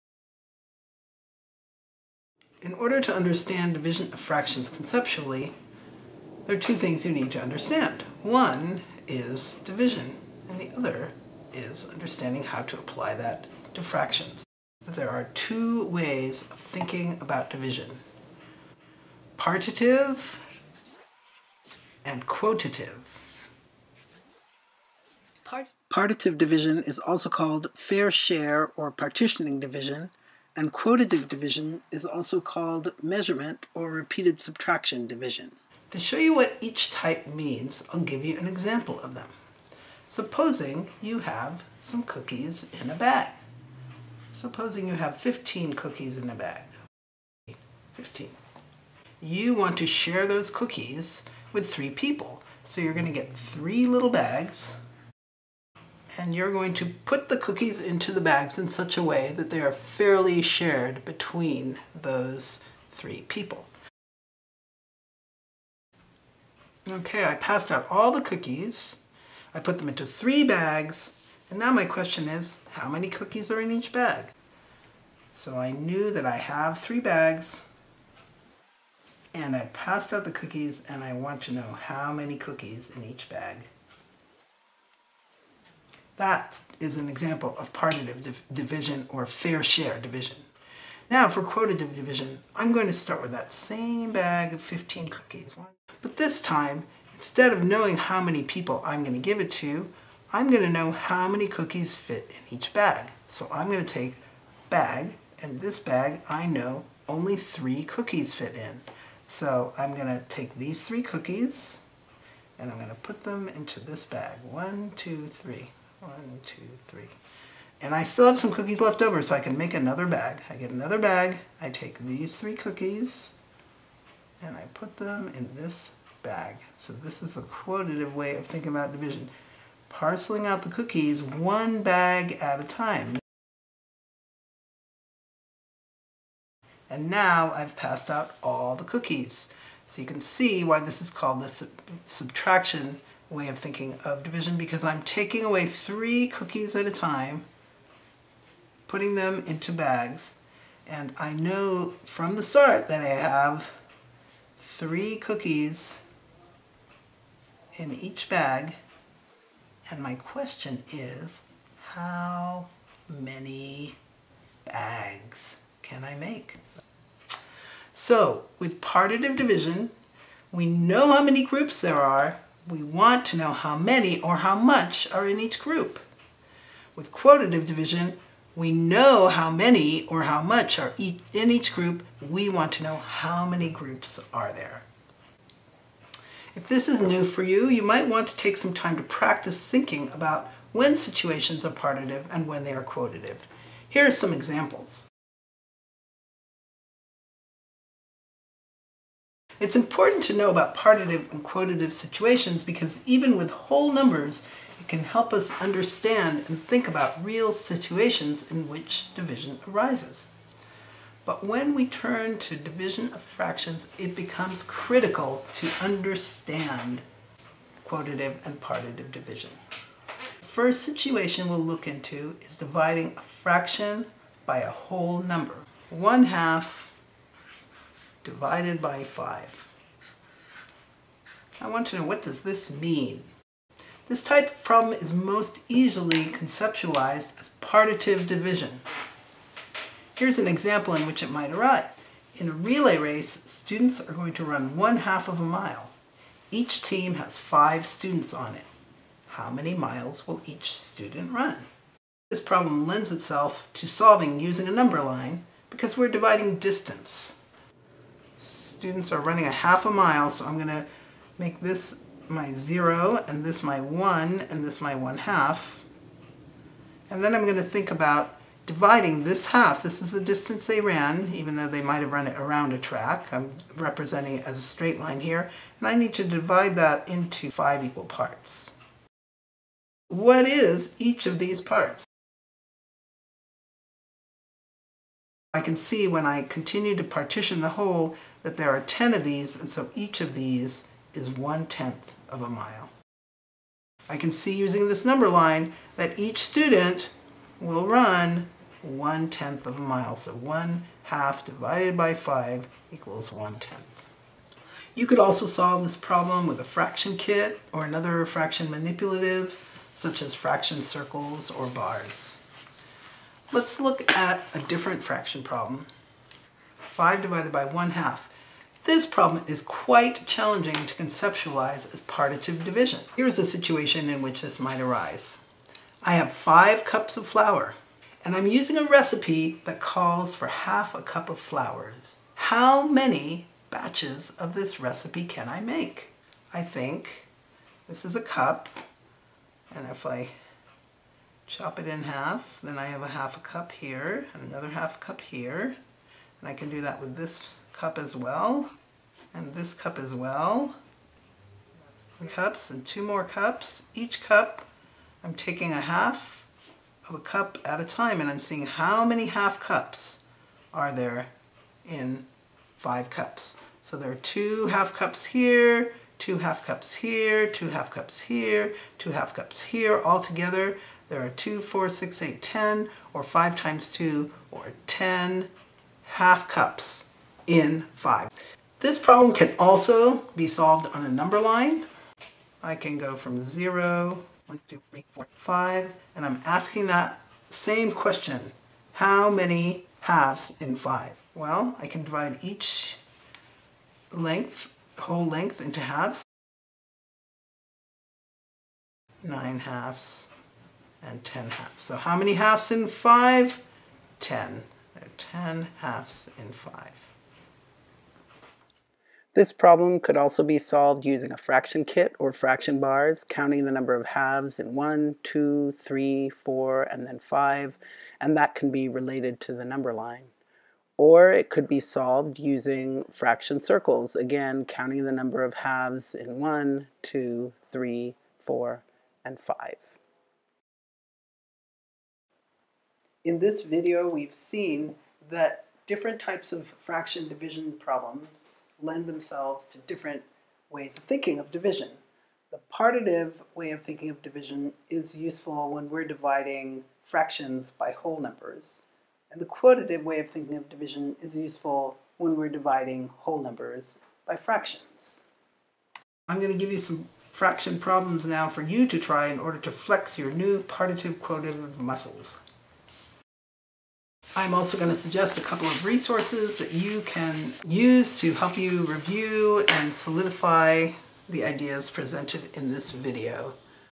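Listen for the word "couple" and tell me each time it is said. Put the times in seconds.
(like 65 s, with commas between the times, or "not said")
465 s.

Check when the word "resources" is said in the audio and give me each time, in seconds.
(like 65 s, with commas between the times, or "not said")
465 s.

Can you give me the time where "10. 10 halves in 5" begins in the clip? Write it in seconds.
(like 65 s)
404 s.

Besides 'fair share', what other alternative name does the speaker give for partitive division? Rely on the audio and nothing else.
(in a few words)
partitioning division.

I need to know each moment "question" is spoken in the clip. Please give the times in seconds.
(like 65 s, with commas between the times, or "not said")
71 s, 160 s, 387 s.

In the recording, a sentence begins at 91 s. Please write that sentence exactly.
Now for quotitive division, I'm going to start with that same bag of 15 cookies.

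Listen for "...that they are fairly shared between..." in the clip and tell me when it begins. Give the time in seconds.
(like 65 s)
59 s.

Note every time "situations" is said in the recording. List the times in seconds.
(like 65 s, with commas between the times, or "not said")
190 s, 201 s, 207 s, 220 s, 323 s.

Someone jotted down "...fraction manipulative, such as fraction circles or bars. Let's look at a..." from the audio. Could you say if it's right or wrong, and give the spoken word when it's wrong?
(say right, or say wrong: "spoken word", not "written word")
right.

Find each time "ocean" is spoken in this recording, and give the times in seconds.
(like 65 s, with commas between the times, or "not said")
not said.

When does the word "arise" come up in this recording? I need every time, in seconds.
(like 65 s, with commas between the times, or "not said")
209 s, 241 s, 324 s.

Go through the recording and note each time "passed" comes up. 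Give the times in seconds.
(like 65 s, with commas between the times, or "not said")
67 s, 79 s, 137 s.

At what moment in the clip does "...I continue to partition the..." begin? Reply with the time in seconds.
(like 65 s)
286 s.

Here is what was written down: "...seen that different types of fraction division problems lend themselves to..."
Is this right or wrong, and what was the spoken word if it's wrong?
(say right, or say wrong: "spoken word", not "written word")
right.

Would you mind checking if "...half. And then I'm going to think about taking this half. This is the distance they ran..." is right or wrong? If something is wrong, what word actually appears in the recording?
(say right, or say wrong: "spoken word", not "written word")
wrong: "dividing", not "taking".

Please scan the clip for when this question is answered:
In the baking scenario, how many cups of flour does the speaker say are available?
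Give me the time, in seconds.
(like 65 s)
326 s.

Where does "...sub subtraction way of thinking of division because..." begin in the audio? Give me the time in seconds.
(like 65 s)
141 s.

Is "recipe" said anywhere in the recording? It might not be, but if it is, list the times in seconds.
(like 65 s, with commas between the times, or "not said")
328 s, 334 s.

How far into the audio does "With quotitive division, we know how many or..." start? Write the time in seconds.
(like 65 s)
176 s.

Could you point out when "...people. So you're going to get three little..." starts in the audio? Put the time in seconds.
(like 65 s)
51 s.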